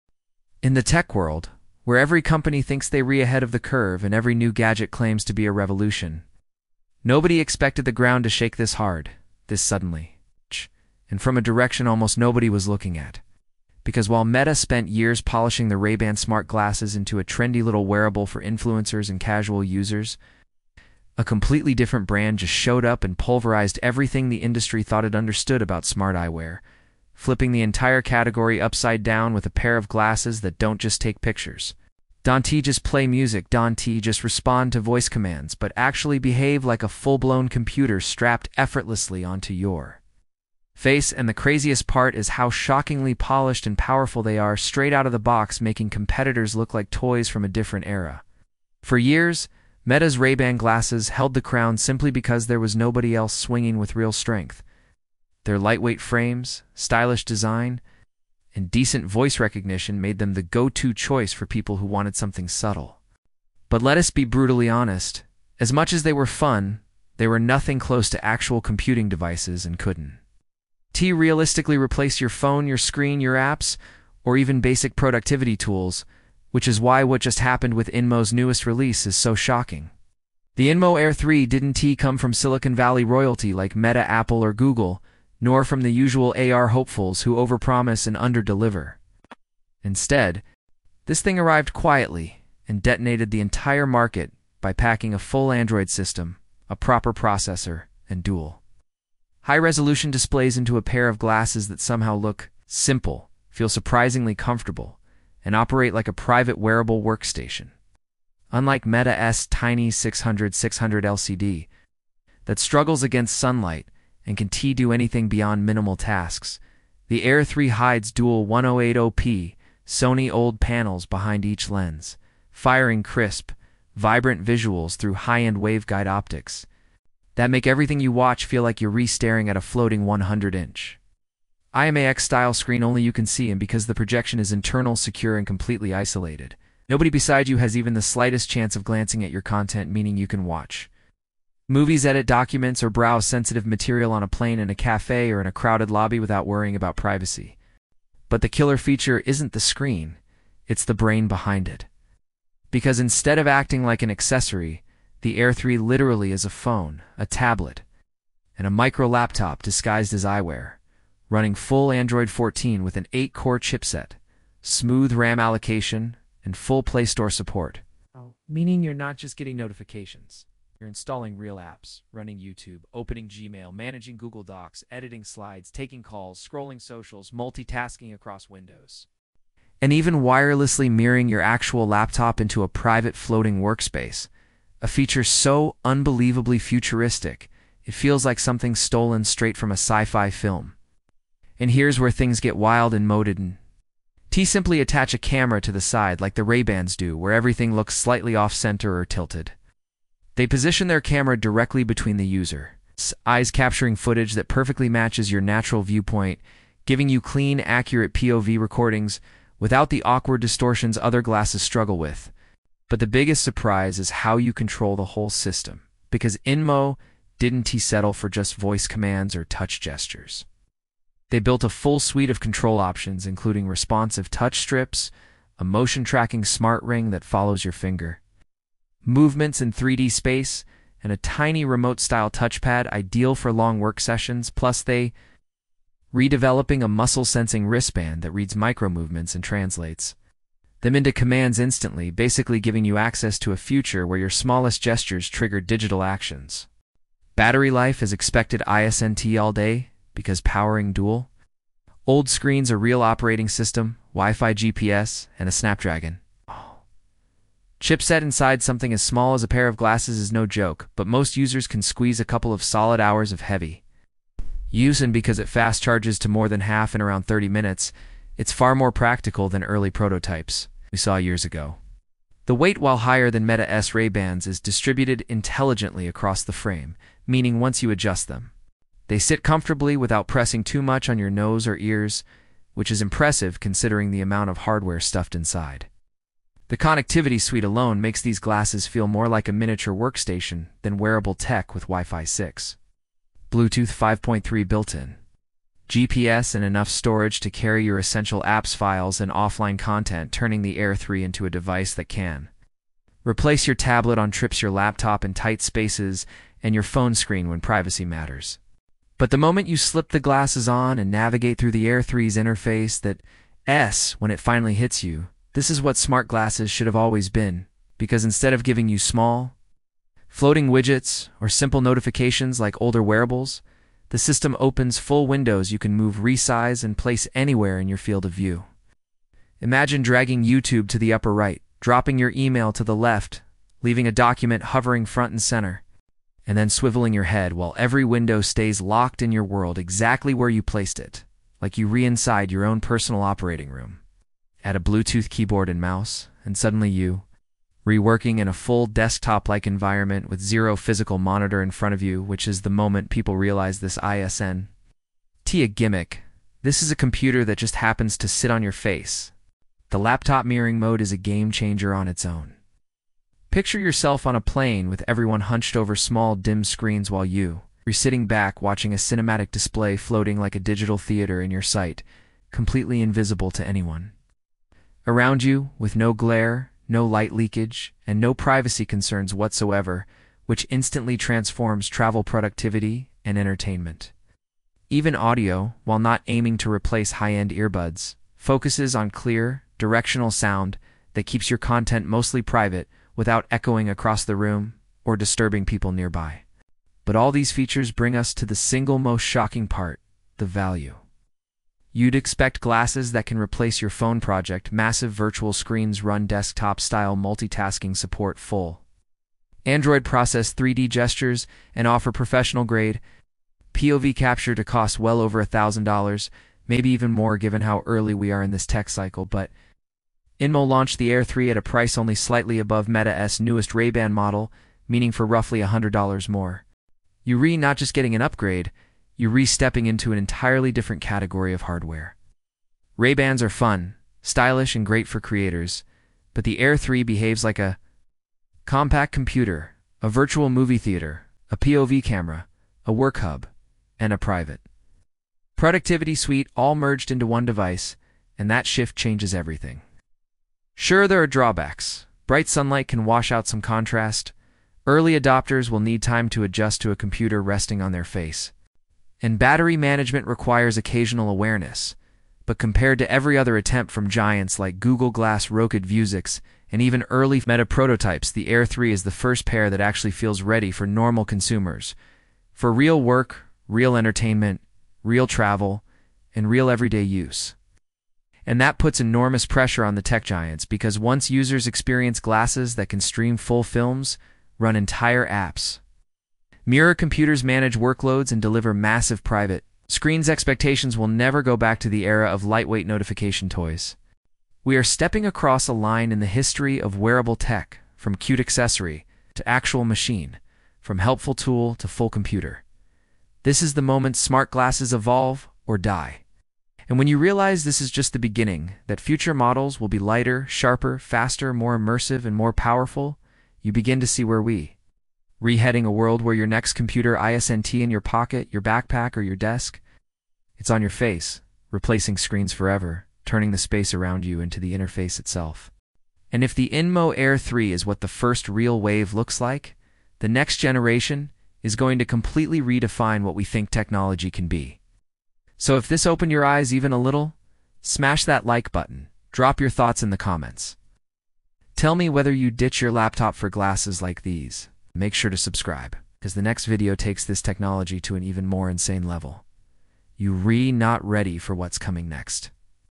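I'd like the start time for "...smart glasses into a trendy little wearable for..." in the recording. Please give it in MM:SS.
00:16.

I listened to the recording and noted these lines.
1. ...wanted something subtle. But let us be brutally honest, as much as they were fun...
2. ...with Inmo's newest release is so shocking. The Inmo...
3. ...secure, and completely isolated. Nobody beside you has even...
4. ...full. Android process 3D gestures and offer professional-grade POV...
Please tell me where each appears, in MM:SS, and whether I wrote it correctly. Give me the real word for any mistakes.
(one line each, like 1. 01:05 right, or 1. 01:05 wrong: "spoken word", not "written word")
1. 01:01 right
2. 01:17 right
3. 02:14 right
4. 06:48 right.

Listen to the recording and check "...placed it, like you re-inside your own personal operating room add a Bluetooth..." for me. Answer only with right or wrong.
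right.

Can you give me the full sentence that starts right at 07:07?
you not just getting an upgrade, you're re-stepping into an entirely different category of hardware.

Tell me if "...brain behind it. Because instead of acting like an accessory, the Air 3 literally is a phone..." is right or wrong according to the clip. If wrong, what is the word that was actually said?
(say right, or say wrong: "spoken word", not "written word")
right.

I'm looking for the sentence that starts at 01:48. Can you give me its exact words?
Unlike Meta S Tiny 600-600 LCD that struggles against sunlight and can T do anything beyond minimal tasks.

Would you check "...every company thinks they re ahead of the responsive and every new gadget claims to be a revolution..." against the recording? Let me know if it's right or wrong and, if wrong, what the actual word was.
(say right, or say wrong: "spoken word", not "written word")
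wrong: "curve", not "responsive".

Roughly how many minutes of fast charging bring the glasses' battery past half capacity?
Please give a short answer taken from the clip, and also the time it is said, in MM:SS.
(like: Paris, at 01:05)
30 minutes, at 04:27.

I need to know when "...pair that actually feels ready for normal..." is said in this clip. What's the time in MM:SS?
07:49.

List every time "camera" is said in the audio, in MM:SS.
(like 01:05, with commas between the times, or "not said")
03:15, 03:21, 07:22.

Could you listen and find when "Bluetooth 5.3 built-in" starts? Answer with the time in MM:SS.
04:53.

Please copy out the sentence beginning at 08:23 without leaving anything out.
This is the moment smart glasses evolve or die.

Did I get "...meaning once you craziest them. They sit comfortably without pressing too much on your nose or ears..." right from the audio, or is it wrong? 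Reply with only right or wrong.
wrong.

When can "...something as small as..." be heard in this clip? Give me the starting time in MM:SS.
04:18.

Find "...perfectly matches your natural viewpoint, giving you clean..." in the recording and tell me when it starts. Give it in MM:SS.
03:24.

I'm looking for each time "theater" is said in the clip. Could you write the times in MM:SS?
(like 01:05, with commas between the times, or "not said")
06:10, 07:20.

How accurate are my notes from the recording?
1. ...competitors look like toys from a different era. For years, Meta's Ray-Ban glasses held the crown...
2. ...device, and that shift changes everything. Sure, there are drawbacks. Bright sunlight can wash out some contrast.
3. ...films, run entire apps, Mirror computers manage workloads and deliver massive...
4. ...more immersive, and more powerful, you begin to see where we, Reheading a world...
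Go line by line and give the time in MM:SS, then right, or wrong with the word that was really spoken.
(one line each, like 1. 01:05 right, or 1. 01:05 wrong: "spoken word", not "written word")
1. 00:45 right
2. 07:27 right
3. 08:03 right
4. 08:31 right.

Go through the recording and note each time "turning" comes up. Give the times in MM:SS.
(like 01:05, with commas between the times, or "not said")
05:00, 08:43.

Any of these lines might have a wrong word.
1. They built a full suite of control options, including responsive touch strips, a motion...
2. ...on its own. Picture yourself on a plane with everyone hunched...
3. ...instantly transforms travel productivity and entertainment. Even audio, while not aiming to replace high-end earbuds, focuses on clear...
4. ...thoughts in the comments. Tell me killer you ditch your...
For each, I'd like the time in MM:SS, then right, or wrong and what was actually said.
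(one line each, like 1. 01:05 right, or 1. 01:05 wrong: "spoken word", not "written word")
1. 03:41 right
2. 06:01 right
3. 06:20 right
4. 08:59 wrong: "whether", not "killer".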